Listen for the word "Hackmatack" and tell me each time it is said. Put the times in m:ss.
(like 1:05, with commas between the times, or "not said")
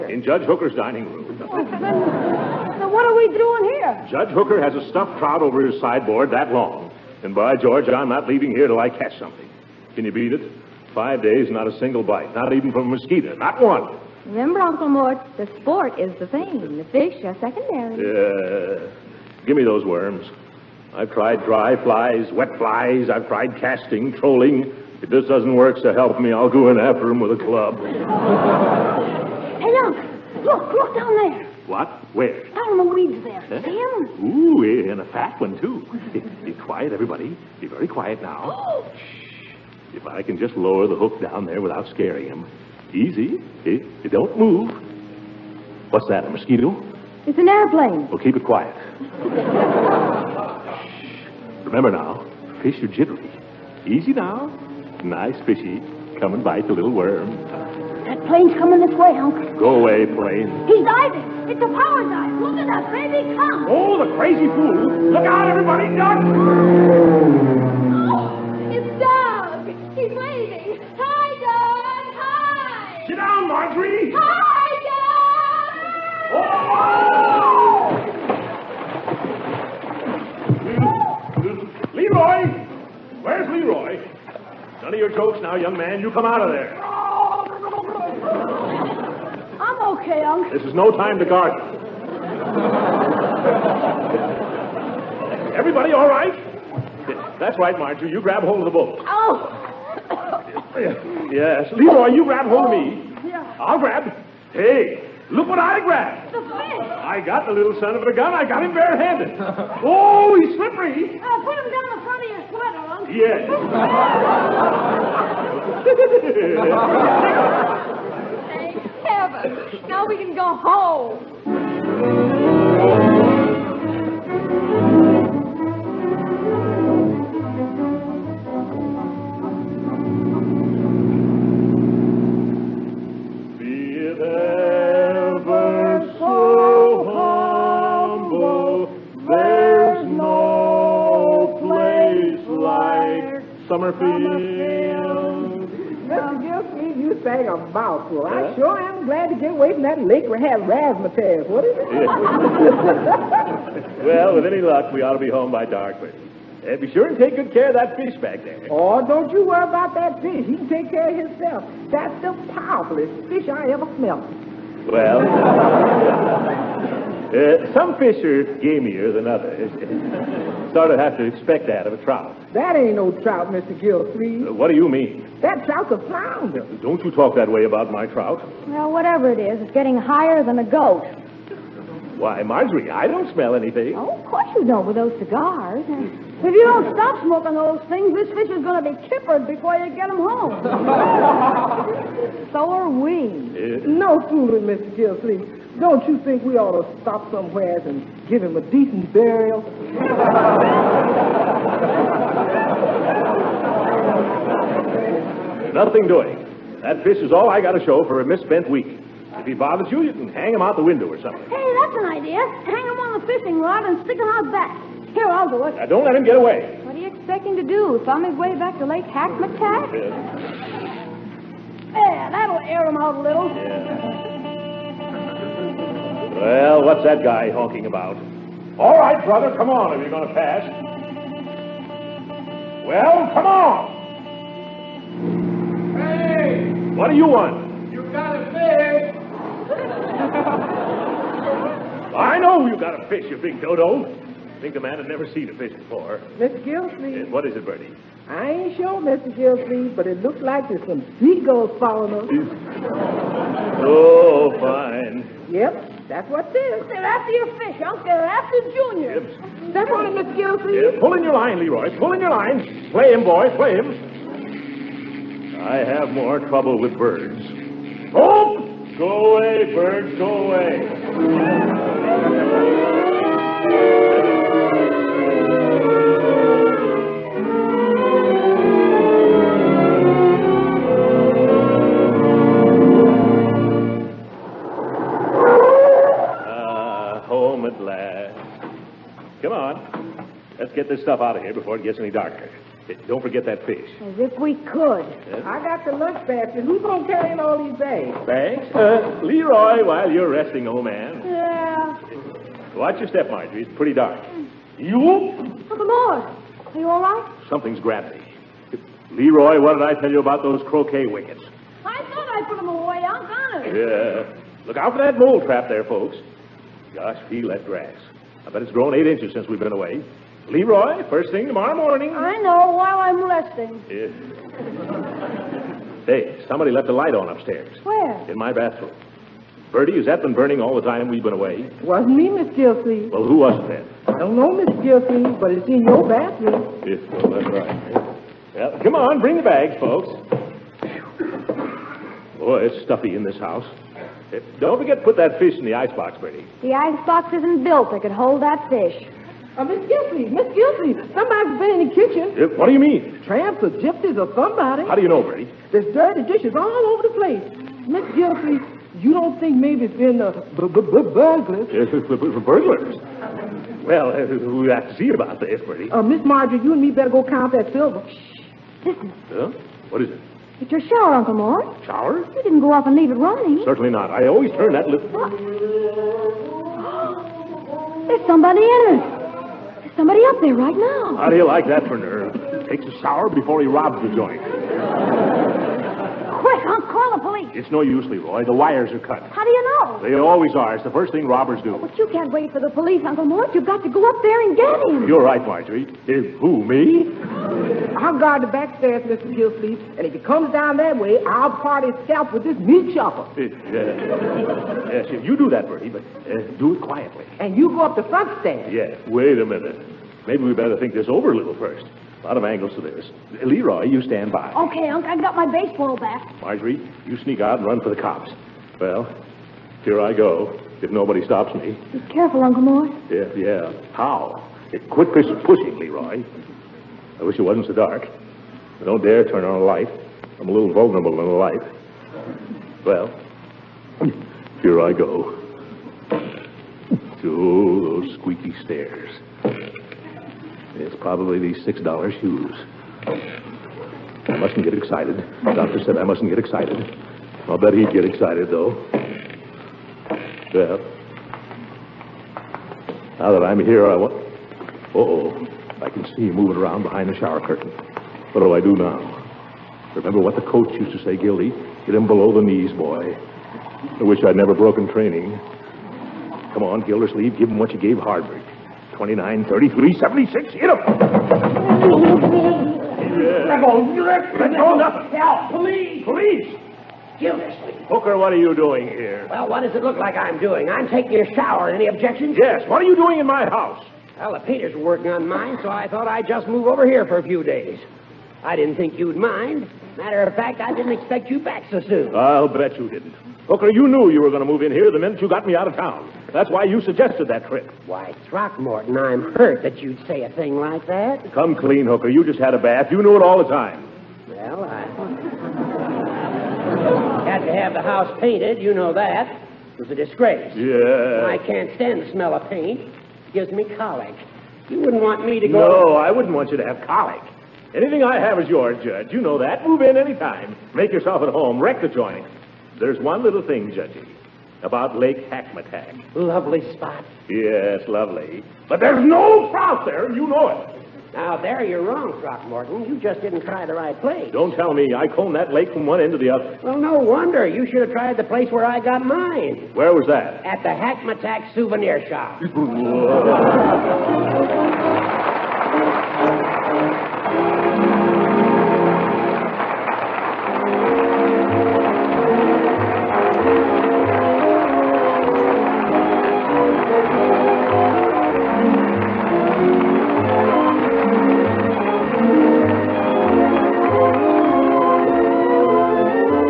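3:39, 8:45, 9:00.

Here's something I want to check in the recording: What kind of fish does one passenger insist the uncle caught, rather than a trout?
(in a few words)
flounder.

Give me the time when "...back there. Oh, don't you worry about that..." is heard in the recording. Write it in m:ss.
2:38.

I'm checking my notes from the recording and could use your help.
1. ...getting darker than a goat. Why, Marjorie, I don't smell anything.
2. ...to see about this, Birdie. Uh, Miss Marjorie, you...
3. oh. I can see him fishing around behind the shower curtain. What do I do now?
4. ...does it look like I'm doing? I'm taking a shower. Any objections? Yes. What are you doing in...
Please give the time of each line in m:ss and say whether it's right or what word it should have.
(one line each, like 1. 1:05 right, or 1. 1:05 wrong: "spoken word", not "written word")
1. 2:59 wrong: "higher", not "darker"
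2. 6:04 right
3. 7:34 wrong: "moving", not "fishing"
4. 7:59 right.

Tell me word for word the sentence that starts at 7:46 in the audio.
Come on, Gildersleeve, give him what you gave Harvard.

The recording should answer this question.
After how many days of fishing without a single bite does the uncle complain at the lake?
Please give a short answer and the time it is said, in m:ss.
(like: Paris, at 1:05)
5, at 0:10.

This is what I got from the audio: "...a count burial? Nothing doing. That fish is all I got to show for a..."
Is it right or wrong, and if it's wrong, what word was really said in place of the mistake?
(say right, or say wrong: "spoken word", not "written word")
wrong: "decent", not "count".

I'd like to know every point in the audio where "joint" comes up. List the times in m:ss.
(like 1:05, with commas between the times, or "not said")
6:24, 8:41.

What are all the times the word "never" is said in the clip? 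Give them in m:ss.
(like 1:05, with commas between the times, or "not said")
4:05, 7:44.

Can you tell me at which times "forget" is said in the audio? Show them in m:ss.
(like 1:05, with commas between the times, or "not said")
4:53, 5:44.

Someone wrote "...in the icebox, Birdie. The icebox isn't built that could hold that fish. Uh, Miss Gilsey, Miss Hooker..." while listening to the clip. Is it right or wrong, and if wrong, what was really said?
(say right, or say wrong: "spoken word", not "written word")
wrong: "Gilsey", not "Hooker".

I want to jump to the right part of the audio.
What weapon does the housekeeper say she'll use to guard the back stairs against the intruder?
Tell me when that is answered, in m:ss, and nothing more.
6:42.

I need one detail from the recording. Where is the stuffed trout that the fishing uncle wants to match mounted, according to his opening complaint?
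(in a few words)
Judge Hooker's dining room.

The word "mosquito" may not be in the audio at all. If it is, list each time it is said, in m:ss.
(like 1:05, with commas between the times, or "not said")
0:12, 0:46.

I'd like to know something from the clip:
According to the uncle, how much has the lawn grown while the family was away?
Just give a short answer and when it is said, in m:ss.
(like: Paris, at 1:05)
8 inches, at 5:18.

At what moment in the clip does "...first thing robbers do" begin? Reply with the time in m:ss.
6:30.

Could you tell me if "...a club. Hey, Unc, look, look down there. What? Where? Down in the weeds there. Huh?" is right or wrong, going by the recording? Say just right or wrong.
right.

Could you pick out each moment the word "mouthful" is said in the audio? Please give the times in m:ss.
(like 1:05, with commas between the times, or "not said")
2:27.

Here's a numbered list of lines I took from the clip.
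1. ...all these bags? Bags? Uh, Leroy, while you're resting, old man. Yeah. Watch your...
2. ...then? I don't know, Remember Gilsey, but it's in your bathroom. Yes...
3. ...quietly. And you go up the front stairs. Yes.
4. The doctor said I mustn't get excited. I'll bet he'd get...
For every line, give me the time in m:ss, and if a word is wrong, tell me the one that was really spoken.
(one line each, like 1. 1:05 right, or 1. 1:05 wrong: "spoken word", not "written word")
1. 4:57 right
2. 5:33 wrong: "Miss", not "Remember"
3. 6:46 right
4. 7:25 right.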